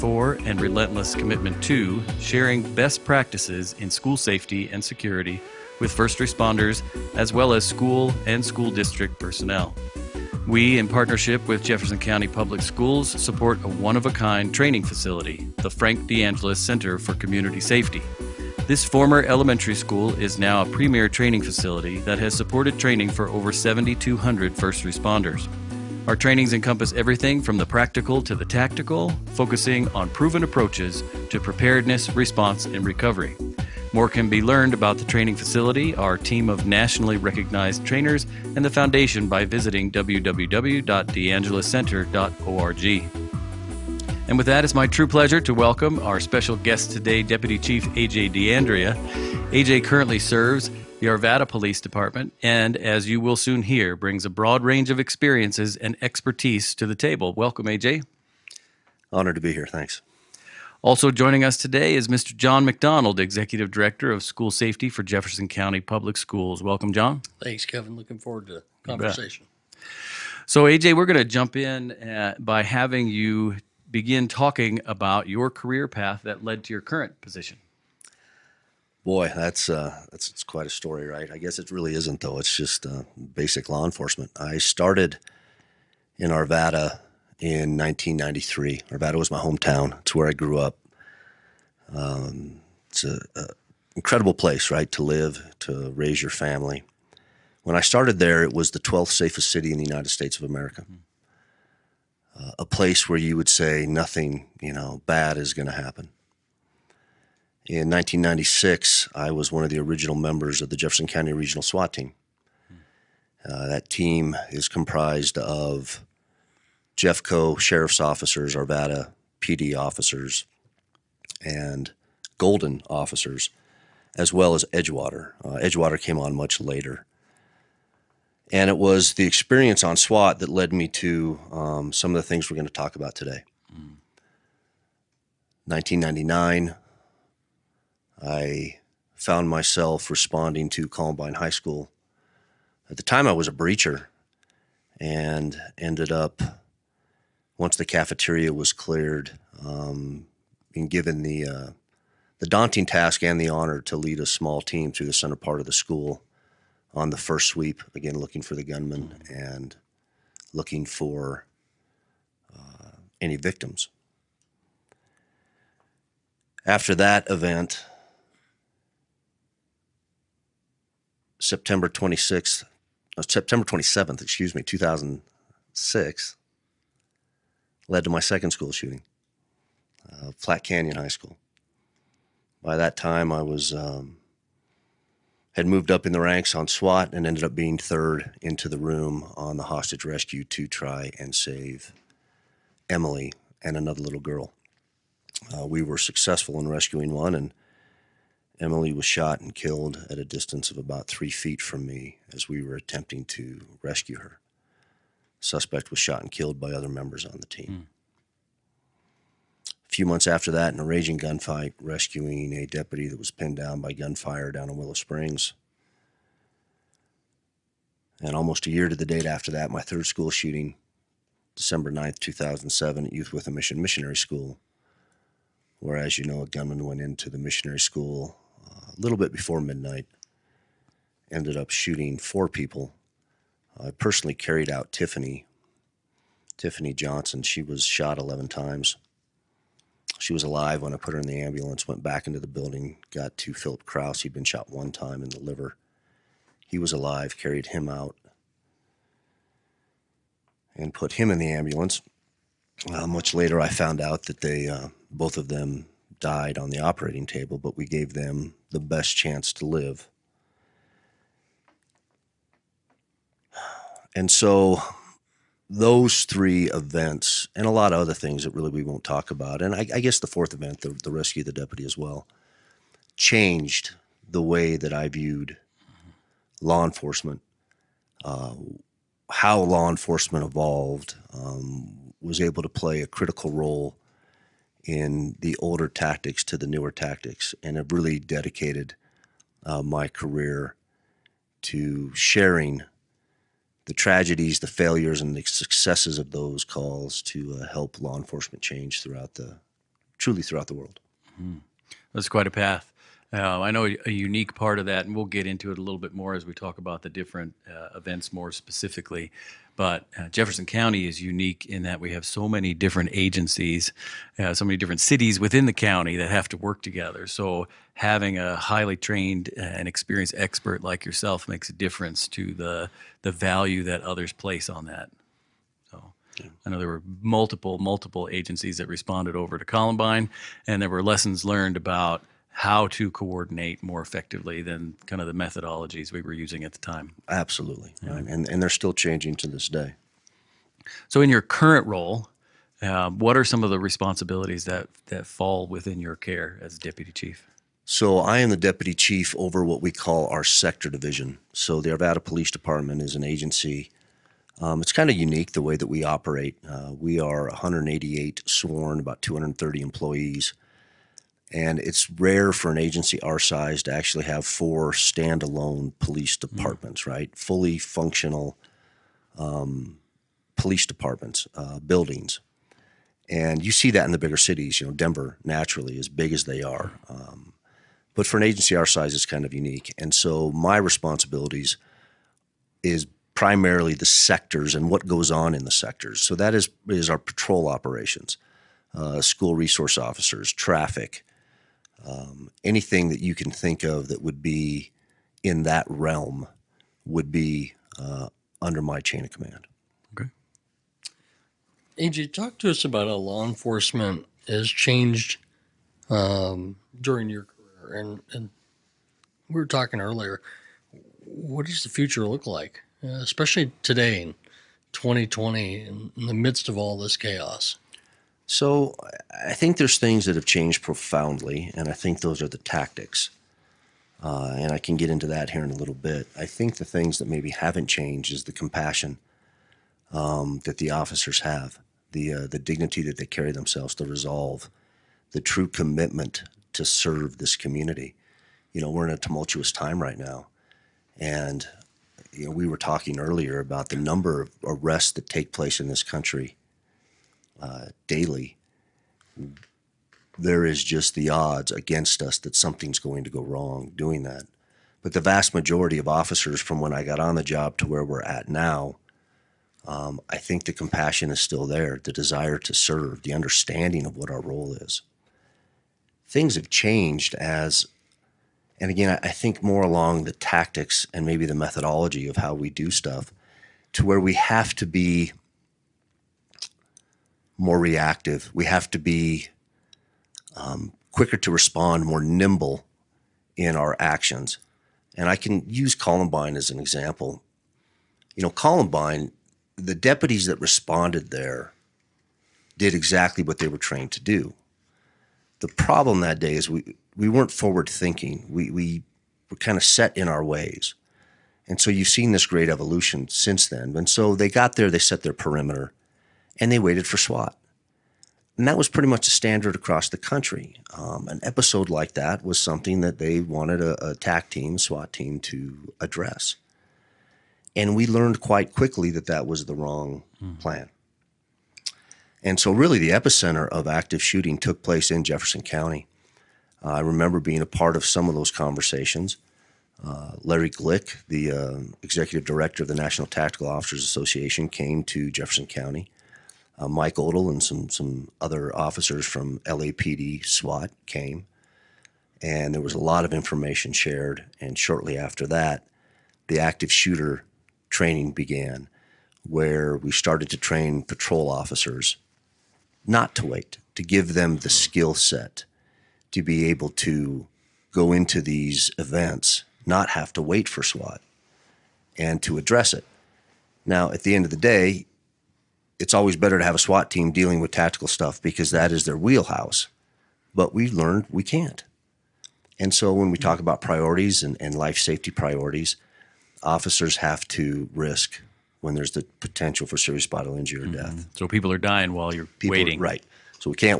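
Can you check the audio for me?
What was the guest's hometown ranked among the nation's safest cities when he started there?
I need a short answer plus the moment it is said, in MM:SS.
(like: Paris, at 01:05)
12th, at 01:38.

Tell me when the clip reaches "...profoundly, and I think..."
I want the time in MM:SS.
07:00.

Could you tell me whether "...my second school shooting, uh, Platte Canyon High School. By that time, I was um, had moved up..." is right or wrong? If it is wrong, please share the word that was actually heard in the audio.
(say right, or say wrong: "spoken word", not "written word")
right.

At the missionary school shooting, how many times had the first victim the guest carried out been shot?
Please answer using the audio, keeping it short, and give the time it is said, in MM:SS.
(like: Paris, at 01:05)
11, at 03:58.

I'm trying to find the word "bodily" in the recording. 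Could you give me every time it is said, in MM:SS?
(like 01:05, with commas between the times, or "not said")
09:40.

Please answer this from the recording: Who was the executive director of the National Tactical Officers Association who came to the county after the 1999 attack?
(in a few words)
Larry Glick.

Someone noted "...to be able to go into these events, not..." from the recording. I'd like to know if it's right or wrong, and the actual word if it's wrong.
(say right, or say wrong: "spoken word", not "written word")
right.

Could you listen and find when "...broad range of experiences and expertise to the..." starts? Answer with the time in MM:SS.
00:54.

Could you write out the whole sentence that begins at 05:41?
So, in your current role, um, what are some of the responsibilities that, that fall within your care as deputy chief?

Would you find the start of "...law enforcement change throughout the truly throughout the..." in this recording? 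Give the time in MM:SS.
04:58.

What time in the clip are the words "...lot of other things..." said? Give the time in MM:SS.
04:27.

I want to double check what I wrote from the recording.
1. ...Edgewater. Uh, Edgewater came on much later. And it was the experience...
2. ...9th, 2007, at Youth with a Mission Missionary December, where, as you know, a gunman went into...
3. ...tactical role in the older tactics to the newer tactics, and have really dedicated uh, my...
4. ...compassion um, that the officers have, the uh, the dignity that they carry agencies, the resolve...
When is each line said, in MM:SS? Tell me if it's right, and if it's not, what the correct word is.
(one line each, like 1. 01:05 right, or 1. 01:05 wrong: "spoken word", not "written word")
1. 02:04 right
2. 03:41 wrong: "School", not "December"
3. 04:43 wrong: "critical", not "tactical"
4. 07:08 wrong: "themselves", not "agencies".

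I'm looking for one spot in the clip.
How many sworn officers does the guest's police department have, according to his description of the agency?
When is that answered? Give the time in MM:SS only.
05:57.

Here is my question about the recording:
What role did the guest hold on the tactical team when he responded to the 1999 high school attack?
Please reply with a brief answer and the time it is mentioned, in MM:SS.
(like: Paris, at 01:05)
Breacher, at 02:23.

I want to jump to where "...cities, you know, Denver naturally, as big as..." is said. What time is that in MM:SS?
06:14.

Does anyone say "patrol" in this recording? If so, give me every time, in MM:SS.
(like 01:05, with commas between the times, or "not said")
06:27, 09:11.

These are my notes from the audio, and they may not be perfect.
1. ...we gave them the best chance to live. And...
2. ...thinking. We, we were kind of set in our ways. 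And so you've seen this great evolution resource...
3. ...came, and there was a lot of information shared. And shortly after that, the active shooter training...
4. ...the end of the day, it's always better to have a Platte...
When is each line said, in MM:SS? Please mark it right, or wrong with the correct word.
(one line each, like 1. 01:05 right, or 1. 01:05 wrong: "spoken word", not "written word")
1. 04:17 right
2. 08:17 wrong: "since", not "resource"
3. 09:01 right
4. 09:24 wrong: "SWAT", not "Platte".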